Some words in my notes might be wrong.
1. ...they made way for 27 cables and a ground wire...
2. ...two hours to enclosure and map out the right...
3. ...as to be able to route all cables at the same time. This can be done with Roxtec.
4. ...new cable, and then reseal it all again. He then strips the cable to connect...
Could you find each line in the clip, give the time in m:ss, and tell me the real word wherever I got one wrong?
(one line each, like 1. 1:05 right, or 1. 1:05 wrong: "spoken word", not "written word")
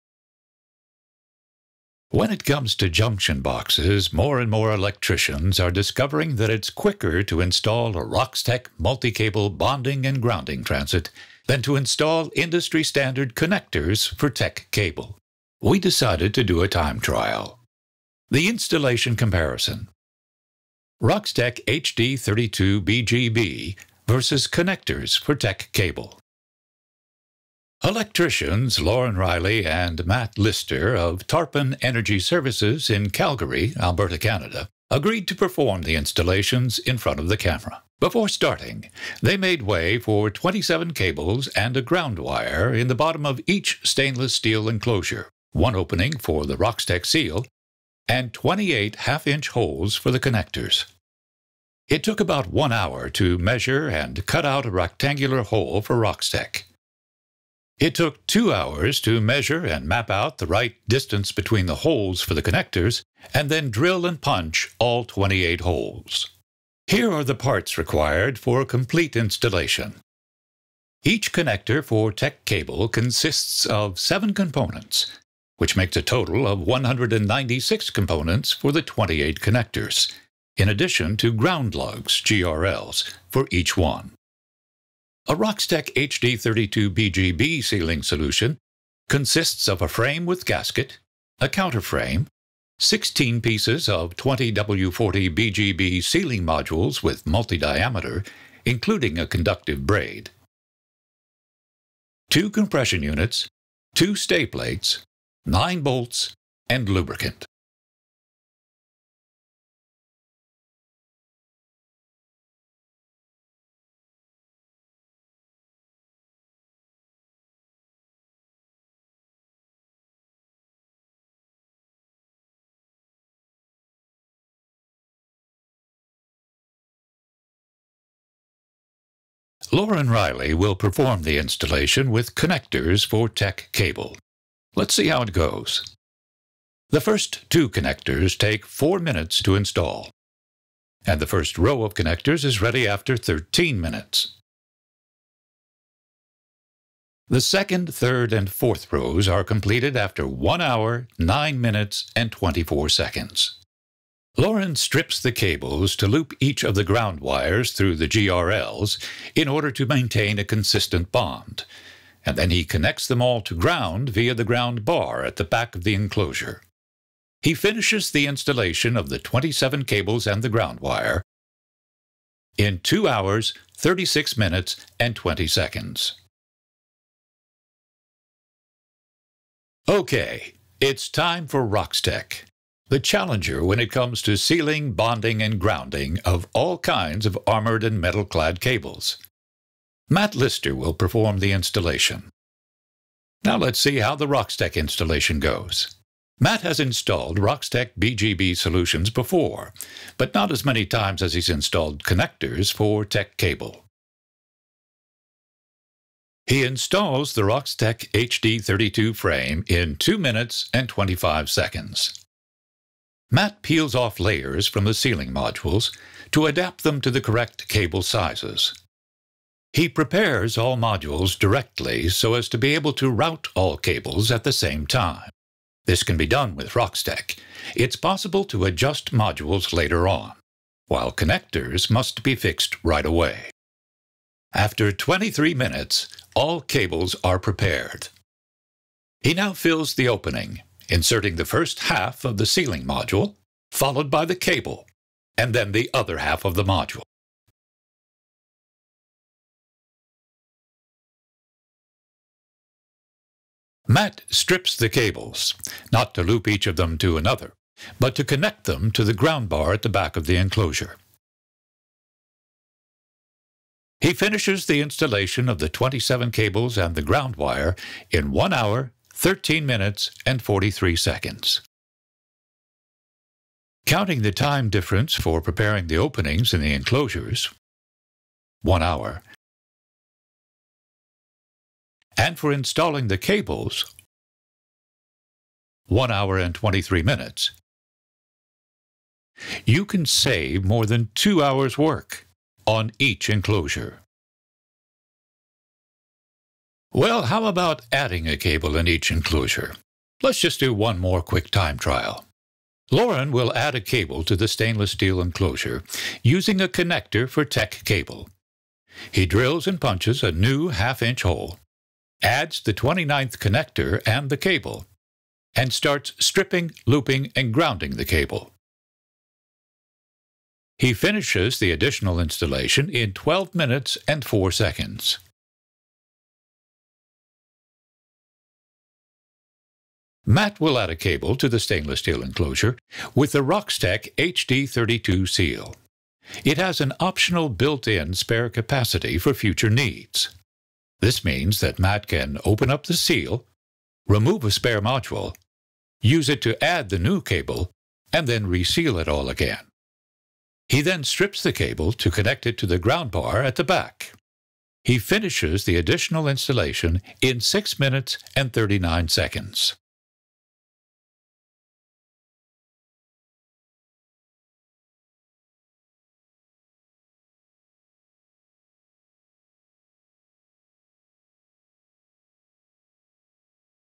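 1. 0:39 right
2. 0:58 wrong: "measure", not "enclosure"
3. 3:42 right
4. 5:46 right.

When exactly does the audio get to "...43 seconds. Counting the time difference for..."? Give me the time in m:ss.
4:30.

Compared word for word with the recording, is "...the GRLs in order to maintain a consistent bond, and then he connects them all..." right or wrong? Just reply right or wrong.
right.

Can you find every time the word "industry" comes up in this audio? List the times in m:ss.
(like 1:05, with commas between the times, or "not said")
0:12.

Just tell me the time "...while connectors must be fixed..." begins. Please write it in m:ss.
3:50.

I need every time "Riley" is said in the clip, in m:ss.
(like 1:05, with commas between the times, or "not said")
0:29, 2:10.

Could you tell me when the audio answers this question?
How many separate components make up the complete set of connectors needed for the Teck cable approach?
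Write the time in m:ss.
1:16.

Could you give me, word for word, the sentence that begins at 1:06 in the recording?
Here are the parts required for a complete installation.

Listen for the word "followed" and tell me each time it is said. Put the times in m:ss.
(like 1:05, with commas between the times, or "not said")
4:03.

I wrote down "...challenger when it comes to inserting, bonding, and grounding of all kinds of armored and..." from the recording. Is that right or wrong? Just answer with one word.
wrong.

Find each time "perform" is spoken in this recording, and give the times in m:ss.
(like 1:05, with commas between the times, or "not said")
0:35, 2:10, 3:10.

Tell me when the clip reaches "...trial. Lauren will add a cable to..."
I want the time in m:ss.
5:01.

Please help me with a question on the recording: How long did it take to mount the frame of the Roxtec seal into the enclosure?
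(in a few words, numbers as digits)
2 minutes 25 seconds.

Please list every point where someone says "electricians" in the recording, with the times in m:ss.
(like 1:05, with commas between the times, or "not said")
0:04, 0:27.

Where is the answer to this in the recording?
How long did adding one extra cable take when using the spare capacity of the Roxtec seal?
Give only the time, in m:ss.
5:57.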